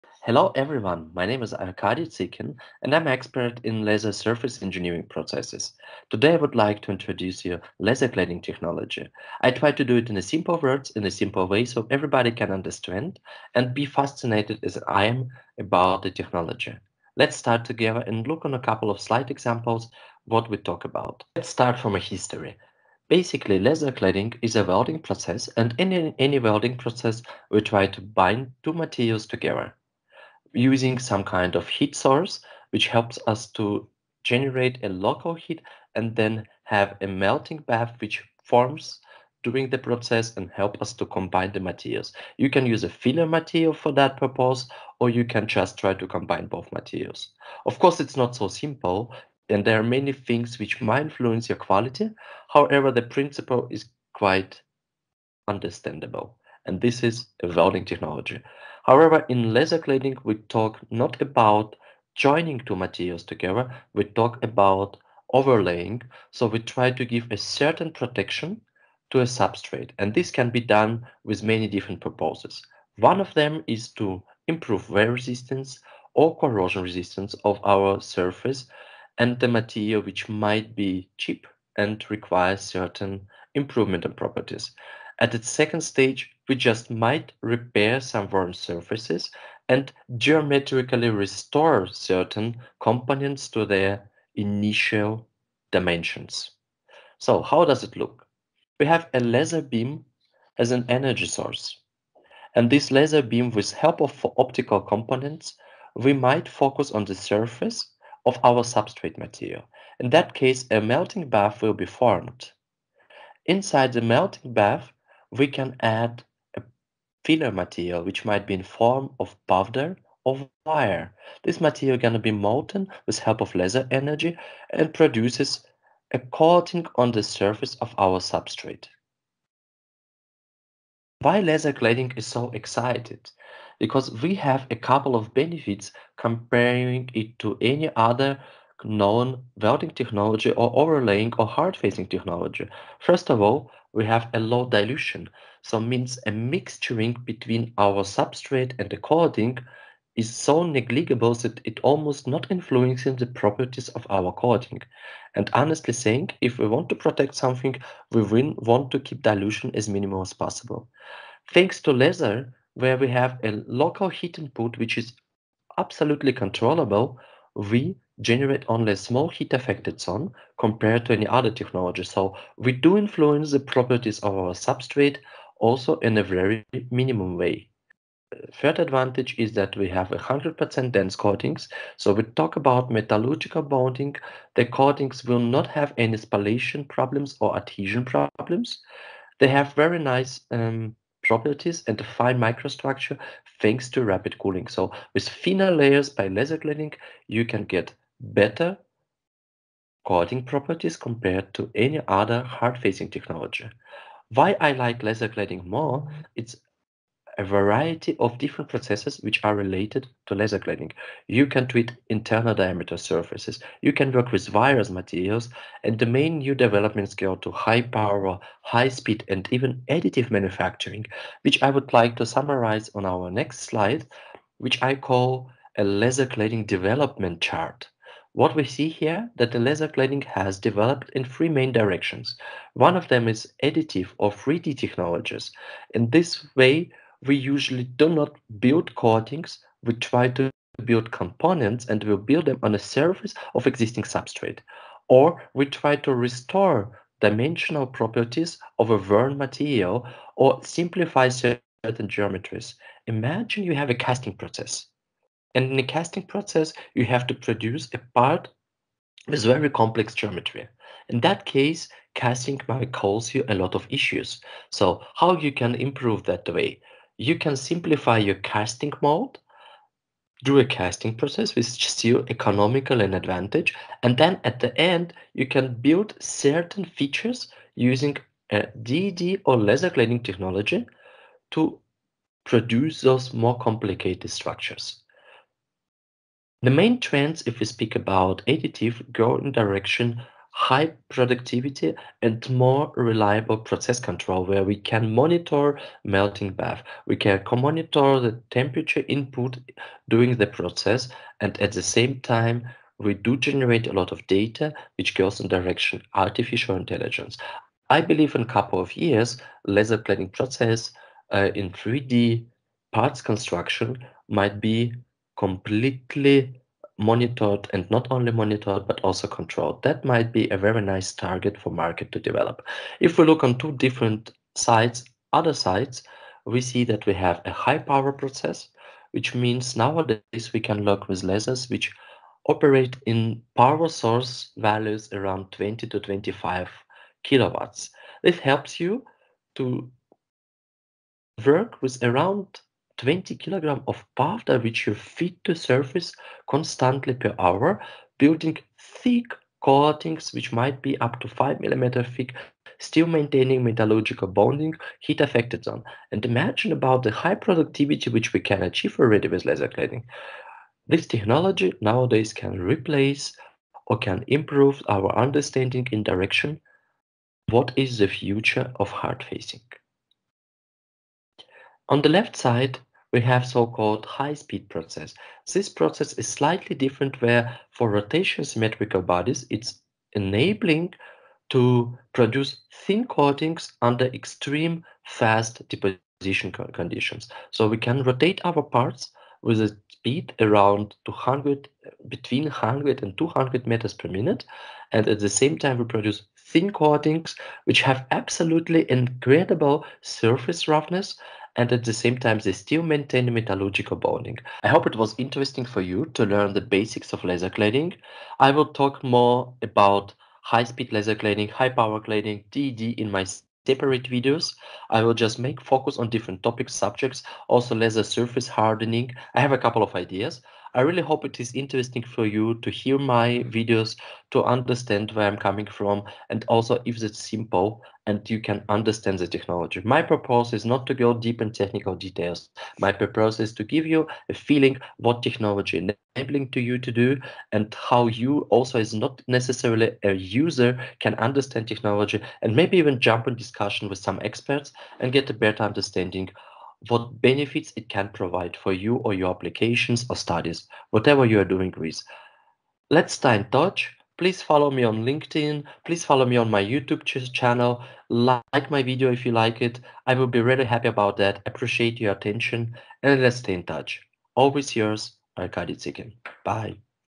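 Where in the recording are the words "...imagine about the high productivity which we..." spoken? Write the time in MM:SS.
05:56.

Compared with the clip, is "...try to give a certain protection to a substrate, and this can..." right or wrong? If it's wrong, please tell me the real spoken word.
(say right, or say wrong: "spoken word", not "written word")
right.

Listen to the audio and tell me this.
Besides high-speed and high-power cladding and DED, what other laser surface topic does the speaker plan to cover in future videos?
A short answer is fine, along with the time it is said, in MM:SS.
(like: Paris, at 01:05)
laser surface hardening, at 06:57.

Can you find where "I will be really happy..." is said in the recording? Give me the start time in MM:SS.
07:40.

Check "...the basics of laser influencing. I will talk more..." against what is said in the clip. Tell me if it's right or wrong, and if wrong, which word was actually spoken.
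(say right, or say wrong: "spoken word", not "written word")
wrong: "cladding", not "influencing".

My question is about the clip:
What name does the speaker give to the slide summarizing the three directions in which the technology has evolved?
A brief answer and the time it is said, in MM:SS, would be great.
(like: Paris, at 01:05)
laser cladding development chart, at 03:45.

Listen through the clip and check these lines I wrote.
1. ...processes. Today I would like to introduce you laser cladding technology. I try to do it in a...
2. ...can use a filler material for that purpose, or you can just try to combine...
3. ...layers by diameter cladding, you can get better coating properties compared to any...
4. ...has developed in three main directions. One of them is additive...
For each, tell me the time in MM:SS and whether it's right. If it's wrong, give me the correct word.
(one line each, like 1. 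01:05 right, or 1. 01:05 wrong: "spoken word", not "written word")
1. 00:05 right
2. 00:42 right
3. 03:15 wrong: "laser", not "diameter"
4. 03:50 right.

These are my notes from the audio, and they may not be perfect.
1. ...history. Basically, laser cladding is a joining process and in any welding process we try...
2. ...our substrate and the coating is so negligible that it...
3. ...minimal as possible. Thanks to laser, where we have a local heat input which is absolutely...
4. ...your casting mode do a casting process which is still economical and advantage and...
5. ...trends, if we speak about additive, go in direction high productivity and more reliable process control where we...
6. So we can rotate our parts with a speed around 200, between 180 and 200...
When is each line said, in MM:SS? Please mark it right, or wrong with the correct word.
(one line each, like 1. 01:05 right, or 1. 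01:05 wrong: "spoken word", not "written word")
1. 00:21 wrong: "welding", not "joining"
2. 02:27 right
3. 02:39 right
4. 04:28 right
5. 04:46 right
6. 06:27 wrong: "100", not "180".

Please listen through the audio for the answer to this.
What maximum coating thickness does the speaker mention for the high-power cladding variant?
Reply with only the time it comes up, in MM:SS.
05:51.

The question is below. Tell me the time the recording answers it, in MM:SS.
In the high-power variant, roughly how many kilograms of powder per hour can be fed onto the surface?
05:43.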